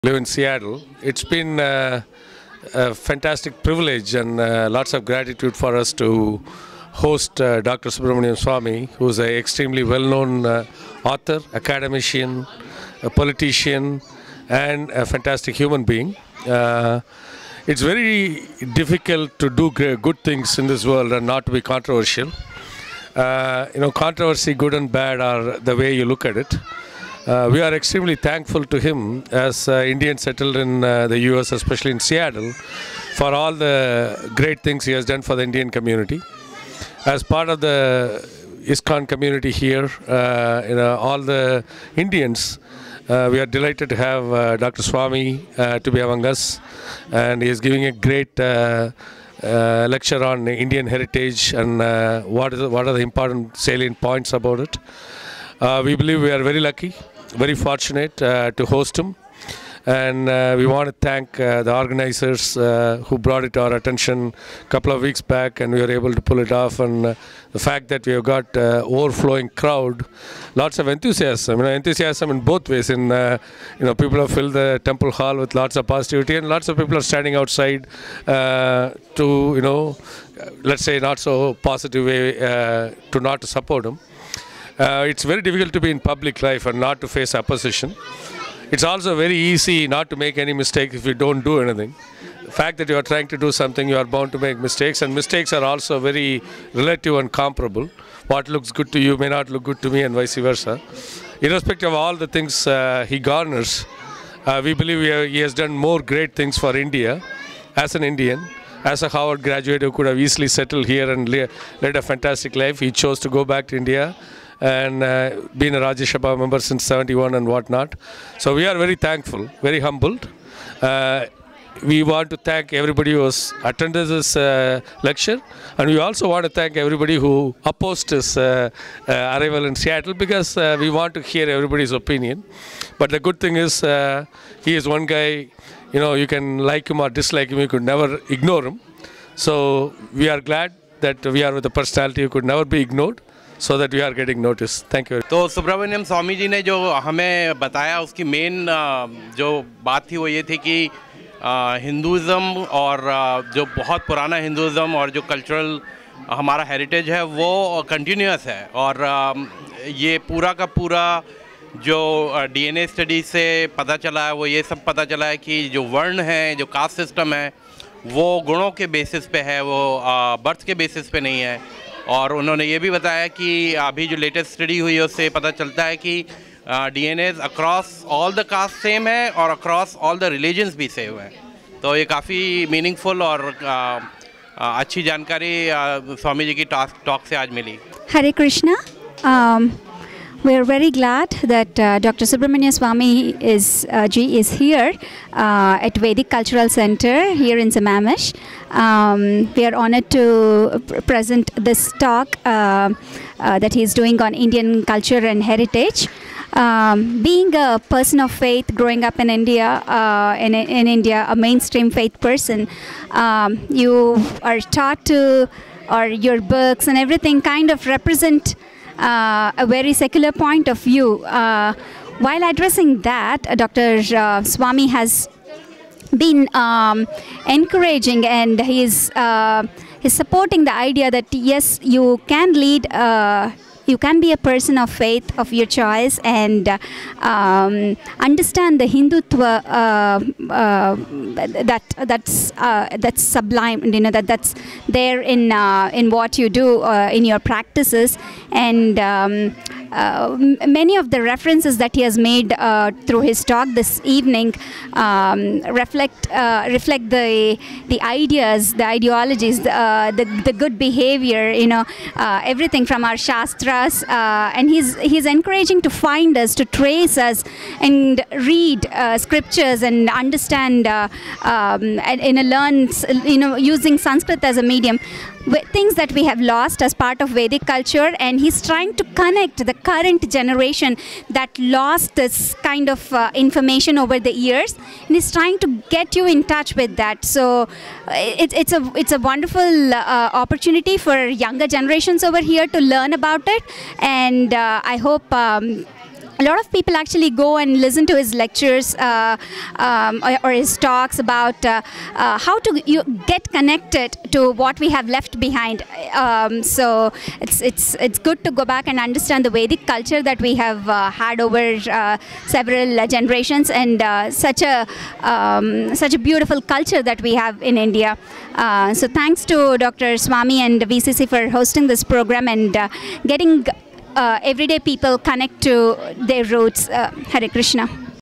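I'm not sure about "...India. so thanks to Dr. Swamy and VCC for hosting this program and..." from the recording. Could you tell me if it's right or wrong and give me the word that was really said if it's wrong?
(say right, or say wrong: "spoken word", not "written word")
right.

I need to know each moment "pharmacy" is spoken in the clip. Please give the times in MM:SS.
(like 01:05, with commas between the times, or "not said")
not said.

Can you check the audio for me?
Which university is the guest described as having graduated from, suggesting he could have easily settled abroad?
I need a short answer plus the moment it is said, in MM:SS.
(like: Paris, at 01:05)
Harvard, at 01:49.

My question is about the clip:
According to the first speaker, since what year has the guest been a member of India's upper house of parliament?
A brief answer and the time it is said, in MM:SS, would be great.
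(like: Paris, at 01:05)
1971, at 01:56.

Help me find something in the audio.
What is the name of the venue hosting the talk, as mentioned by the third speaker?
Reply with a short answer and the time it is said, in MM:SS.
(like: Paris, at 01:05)
Vedic Cultural Center, at 03:15.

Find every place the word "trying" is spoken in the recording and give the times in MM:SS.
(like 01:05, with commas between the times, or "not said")
01:33, 04:38, 04:45.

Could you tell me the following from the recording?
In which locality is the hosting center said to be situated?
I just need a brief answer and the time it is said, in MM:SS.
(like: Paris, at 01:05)
Sammamish, at 03:17.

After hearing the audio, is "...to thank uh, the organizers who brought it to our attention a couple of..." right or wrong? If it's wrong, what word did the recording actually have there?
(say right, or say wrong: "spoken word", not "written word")
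right.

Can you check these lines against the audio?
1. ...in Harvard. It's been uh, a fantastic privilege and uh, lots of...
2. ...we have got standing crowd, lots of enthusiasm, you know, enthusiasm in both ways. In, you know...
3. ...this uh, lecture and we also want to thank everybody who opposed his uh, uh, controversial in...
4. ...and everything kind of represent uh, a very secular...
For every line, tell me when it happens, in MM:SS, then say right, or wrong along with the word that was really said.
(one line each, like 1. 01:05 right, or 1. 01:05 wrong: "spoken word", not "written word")
1. 00:00 wrong: "Seattle", not "Harvard"
2. 01:08 wrong: "overflowing", not "standing"
3. 02:04 wrong: "arrival", not "controversial"
4. 03:36 right.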